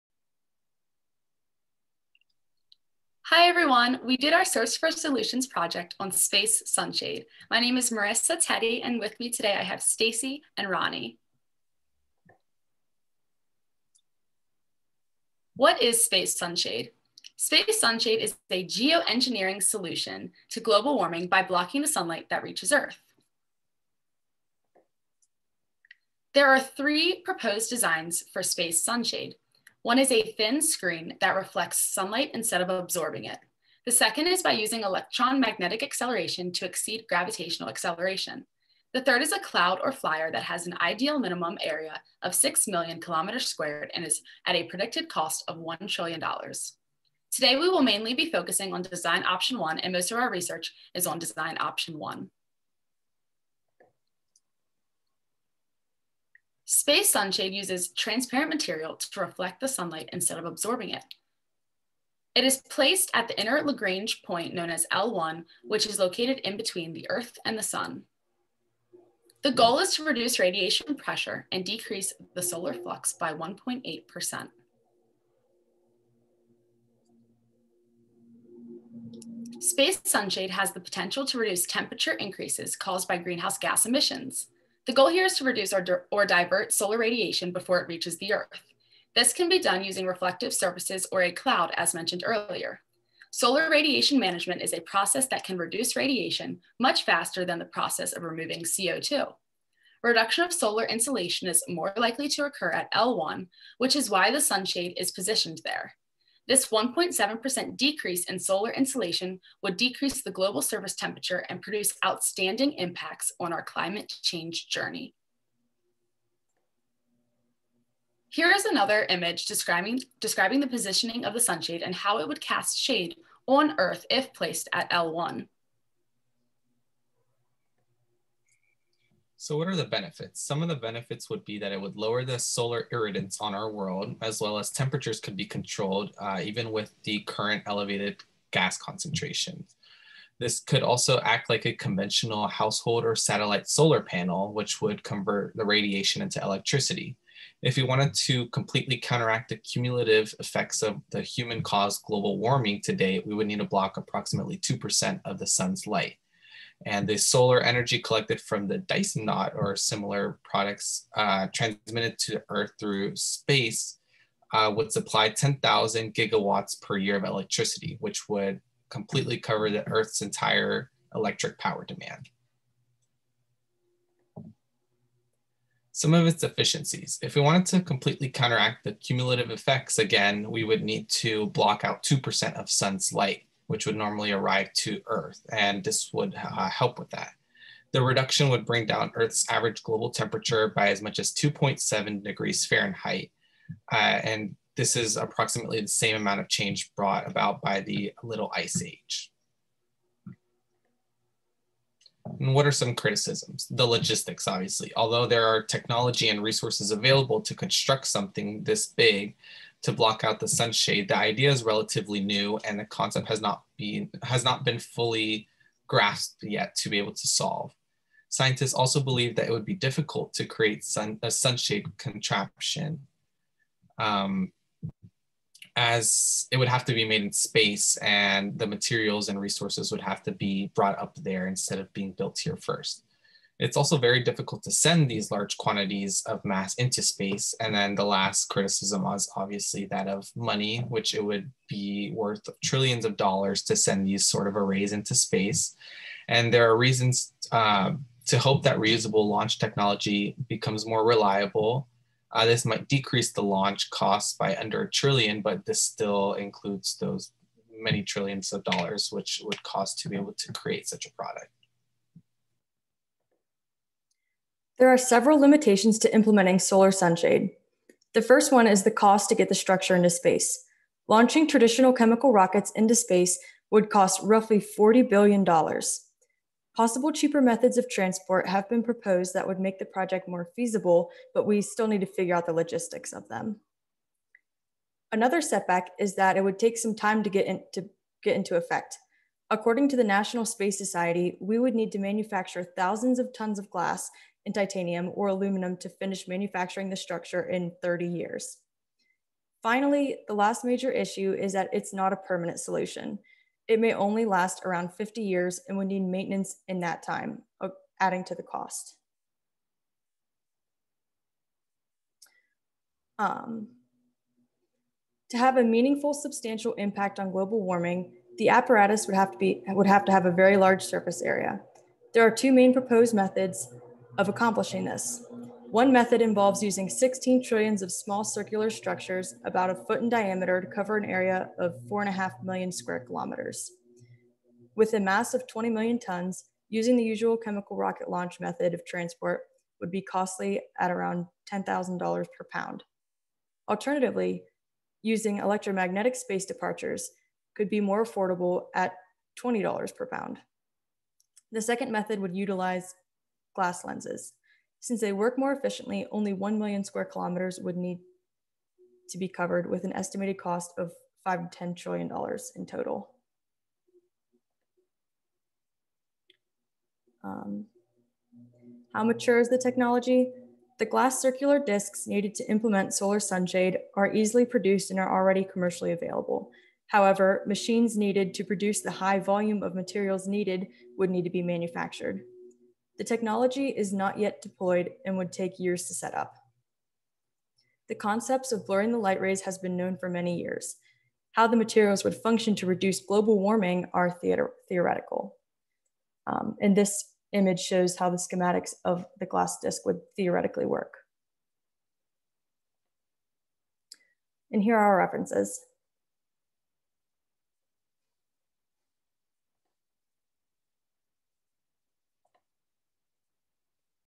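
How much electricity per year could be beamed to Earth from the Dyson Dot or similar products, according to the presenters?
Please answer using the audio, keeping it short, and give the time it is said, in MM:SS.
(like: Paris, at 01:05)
10,000 gigawatts, at 02:45.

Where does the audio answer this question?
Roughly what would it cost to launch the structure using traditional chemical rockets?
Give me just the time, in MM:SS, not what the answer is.
04:34.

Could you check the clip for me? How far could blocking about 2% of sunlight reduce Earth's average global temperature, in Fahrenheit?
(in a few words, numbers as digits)
2.7 degrees Fahrenheit.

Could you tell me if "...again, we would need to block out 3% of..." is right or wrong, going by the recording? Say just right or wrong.
wrong.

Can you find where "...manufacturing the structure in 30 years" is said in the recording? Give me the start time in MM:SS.
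04:56.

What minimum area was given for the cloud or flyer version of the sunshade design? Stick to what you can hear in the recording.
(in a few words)
6 million square kilometers.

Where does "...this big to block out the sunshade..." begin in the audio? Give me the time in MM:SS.
03:28.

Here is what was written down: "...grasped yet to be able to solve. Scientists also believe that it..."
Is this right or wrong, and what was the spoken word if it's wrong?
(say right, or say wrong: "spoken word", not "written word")
right.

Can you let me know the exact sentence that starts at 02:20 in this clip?
This could also act like a conventional household or satellite solar panel, which would convert the radiation into electricity.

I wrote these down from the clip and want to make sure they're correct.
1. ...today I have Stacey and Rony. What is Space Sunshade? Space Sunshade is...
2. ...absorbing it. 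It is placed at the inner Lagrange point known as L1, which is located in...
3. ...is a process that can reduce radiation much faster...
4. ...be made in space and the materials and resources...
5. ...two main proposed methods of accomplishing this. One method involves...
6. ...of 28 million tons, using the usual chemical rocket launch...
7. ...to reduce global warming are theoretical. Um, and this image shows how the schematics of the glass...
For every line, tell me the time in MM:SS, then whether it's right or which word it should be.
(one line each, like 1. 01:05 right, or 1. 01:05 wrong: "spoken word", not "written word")
1. 00:09 right
2. 01:00 right
3. 01:34 right
4. 03:46 right
5. 05:22 right
6. 05:35 wrong: "20", not "28"
7. 06:32 right.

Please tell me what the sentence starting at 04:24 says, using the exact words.
There are several limitations to implementing solar sunshade.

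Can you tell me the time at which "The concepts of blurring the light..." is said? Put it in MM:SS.
06:27.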